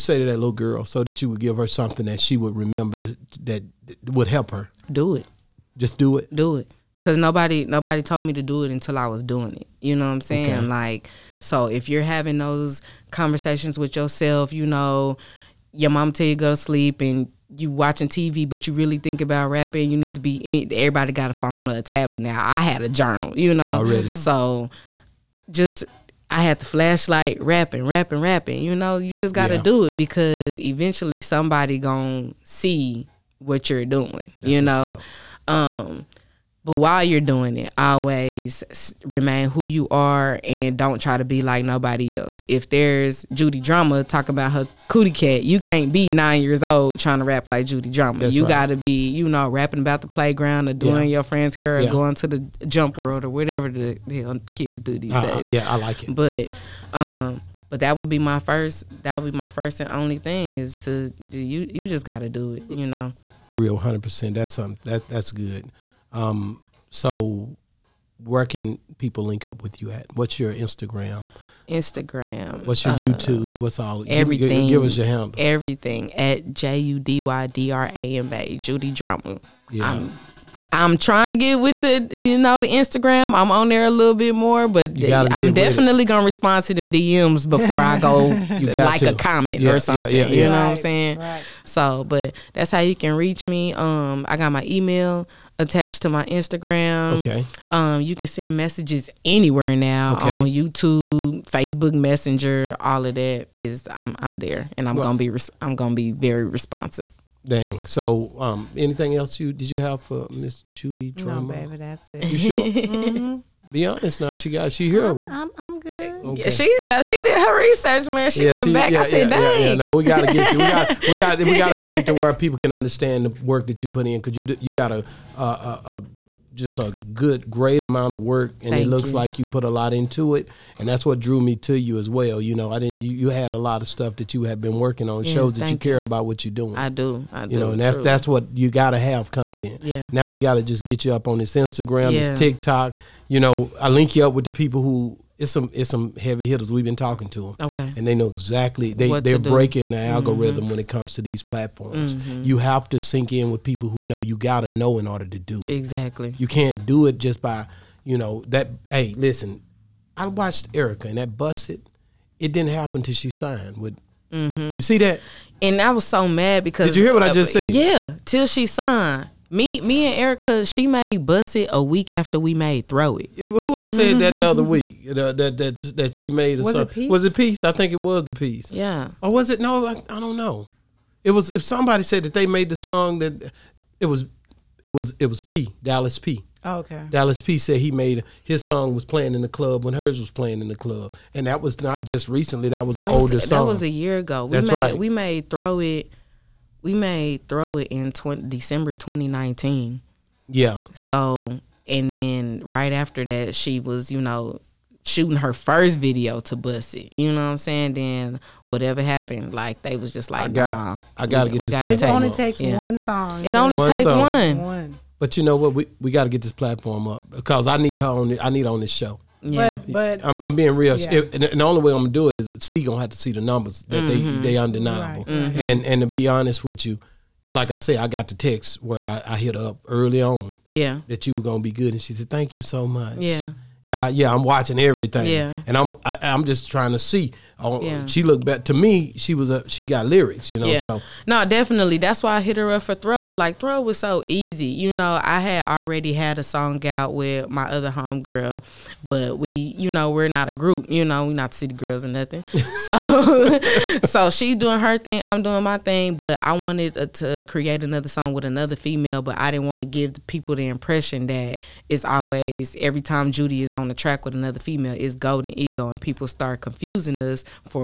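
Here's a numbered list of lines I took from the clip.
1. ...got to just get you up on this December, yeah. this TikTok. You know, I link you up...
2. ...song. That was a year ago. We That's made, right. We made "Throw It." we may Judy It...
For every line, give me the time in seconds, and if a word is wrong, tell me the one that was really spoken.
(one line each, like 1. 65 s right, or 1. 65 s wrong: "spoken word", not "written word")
1. 140 s wrong: "Instagram", not "December"
2. 193 s wrong: "Throw", not "Judy".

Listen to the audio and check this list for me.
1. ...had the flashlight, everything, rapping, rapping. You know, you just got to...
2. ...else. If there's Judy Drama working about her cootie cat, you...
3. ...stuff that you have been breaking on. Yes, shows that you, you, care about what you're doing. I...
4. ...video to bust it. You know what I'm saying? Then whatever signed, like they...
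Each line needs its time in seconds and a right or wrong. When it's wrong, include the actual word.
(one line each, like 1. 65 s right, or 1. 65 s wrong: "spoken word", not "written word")
1. 26 s wrong: "rapping", not "everything"
2. 42 s wrong: "talking", not "working"
3. 133 s wrong: "working", not "breaking"
4. 205 s wrong: "happened", not "signed".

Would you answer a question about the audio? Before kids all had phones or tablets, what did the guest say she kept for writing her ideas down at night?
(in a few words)
Journal.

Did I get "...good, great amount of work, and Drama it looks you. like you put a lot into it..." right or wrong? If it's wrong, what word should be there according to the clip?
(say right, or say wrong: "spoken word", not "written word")
wrong: "Thank", not "Drama".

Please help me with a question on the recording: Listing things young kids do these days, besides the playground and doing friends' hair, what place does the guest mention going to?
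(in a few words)
Jump World.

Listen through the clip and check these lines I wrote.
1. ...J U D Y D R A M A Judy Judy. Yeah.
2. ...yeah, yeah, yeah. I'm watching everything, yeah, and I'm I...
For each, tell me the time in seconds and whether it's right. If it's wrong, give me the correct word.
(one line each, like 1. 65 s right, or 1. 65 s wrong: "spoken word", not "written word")
1. 76 s wrong: "Drama", not "Judy"
2. 233 s right.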